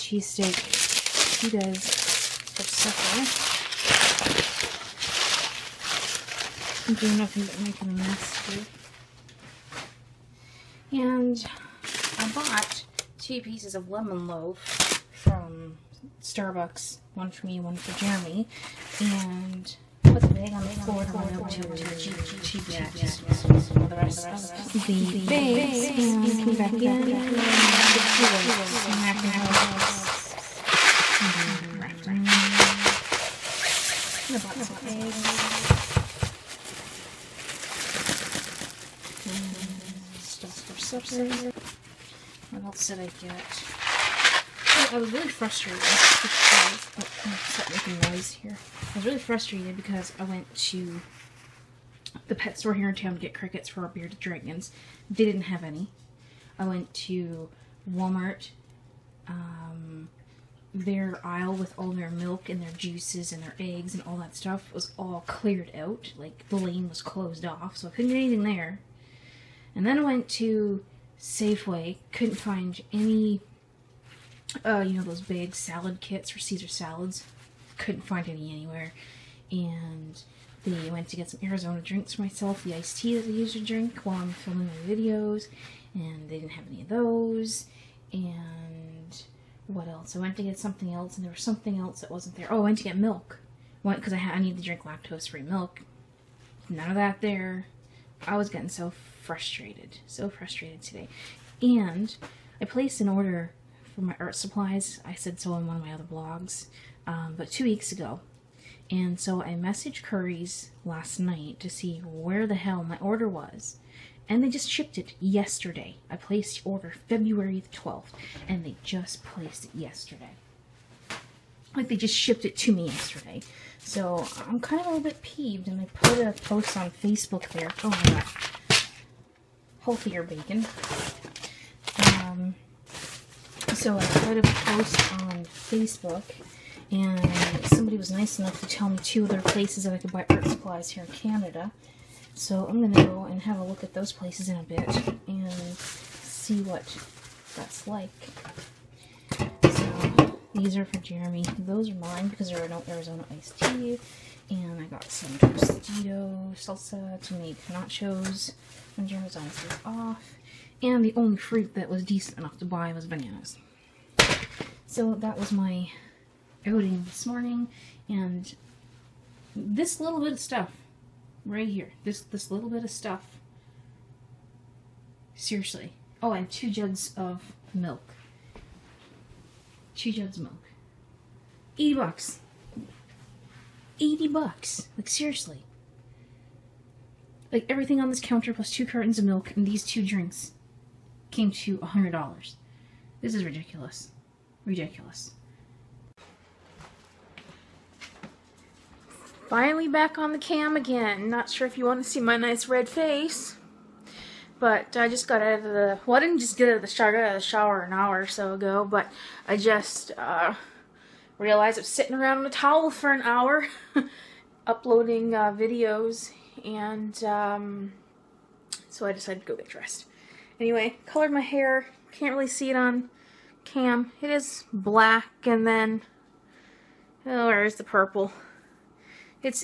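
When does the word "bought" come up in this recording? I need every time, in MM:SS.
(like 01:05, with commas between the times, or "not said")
00:12, 00:34.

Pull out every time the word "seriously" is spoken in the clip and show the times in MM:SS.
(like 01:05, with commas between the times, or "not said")
02:55, 03:05.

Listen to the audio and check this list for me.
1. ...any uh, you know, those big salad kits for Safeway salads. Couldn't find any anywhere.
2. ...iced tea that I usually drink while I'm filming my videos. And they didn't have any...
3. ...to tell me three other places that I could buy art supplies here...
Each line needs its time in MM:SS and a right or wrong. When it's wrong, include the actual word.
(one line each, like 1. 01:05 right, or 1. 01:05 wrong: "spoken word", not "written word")
1. 01:12 wrong: "Caesar", not "Safeway"
2. 01:22 right
3. 02:18 wrong: "two", not "three".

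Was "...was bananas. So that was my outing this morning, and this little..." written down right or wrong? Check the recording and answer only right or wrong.
right.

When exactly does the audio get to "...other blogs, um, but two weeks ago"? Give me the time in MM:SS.
01:45.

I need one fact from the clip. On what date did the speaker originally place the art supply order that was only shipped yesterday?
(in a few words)
February 12.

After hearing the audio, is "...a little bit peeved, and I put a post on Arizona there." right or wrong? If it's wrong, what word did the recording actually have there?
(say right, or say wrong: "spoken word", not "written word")
wrong: "Facebook", not "Arizona".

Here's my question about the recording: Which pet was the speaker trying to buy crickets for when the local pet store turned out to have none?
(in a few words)
bearded dragons.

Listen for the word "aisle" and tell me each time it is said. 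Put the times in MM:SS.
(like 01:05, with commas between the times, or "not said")
01:01.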